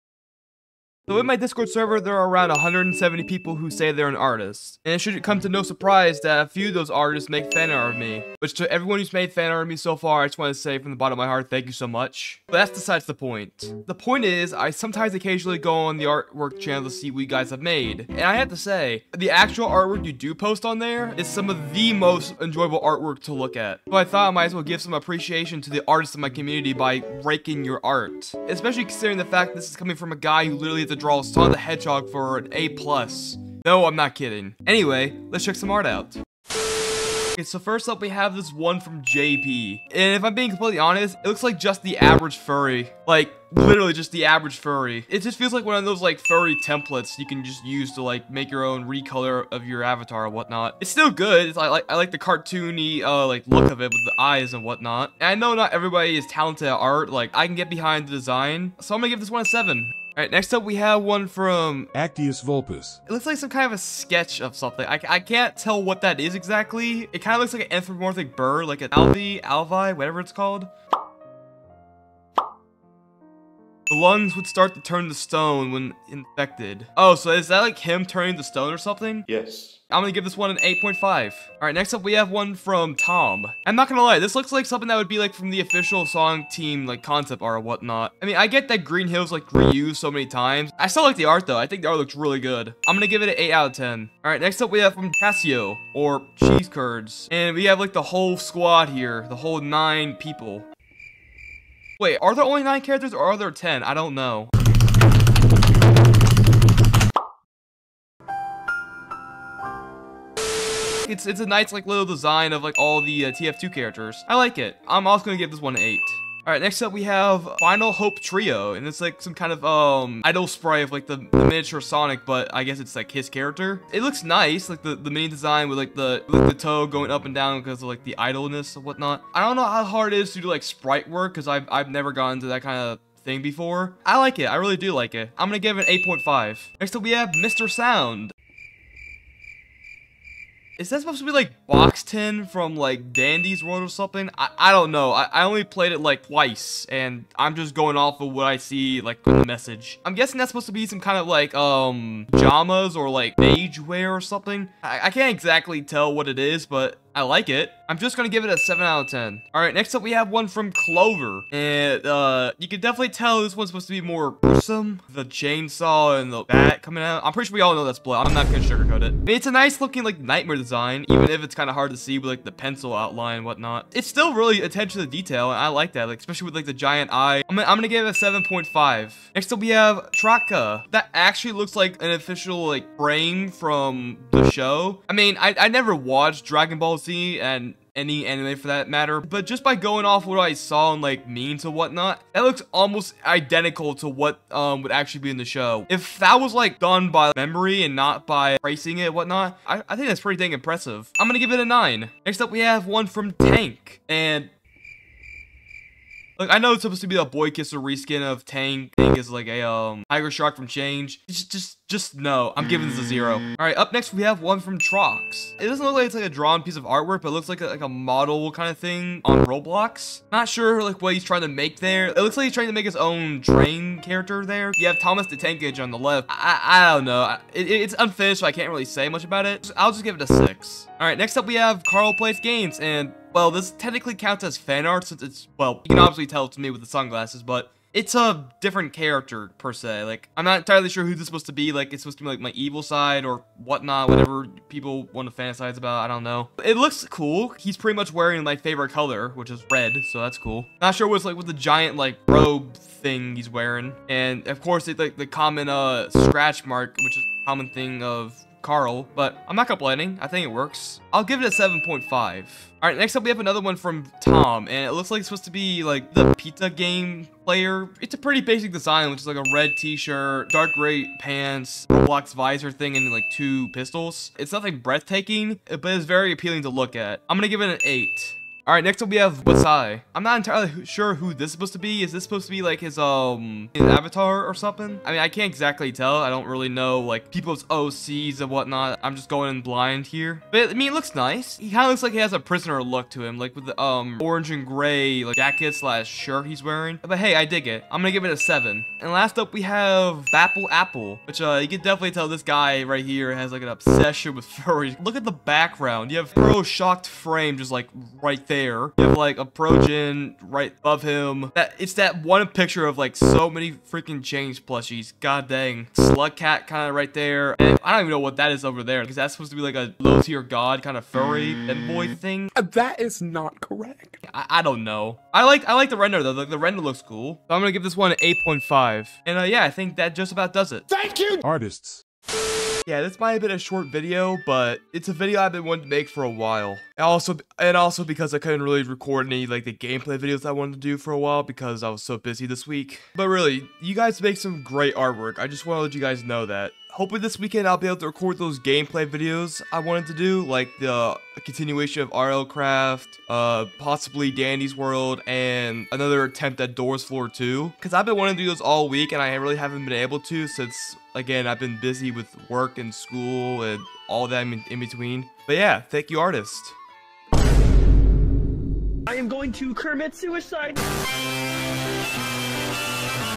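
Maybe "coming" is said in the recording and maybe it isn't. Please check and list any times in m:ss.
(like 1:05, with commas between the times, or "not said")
0:29, 2:46.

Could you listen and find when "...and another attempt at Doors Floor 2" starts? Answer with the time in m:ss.
5:55.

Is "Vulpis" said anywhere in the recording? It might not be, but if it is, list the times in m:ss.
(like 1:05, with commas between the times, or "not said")
1:02.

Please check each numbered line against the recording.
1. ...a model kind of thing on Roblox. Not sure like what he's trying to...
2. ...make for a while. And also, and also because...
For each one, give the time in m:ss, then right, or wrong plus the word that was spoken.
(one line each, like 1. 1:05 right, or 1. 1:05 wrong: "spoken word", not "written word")
1. 3:37 right
2. 5:35 right.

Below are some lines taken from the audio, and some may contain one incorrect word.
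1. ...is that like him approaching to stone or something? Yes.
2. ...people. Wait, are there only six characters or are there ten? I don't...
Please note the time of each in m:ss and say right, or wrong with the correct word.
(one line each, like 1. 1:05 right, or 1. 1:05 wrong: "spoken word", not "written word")
1. 1:17 wrong: "turning", not "approaching"
2. 1:40 wrong: "nine", not "six".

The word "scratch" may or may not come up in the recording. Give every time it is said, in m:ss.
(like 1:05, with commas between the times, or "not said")
4:16.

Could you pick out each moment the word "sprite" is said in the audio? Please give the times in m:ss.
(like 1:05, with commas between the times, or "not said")
2:00, 2:10.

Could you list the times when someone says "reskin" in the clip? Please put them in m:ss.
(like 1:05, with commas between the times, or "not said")
3:27.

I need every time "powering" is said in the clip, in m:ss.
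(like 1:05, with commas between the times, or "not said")
not said.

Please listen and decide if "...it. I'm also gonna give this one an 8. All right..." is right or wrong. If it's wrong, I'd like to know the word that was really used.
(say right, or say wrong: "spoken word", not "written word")
right.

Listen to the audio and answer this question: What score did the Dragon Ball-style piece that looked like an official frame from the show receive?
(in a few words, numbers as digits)
9.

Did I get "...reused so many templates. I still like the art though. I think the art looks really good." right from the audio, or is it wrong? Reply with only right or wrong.
wrong.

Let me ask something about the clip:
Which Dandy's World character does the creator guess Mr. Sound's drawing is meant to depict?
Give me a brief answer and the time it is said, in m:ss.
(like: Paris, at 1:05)
Boxten, at 2:21.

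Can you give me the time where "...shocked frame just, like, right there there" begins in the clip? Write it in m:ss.
5:06.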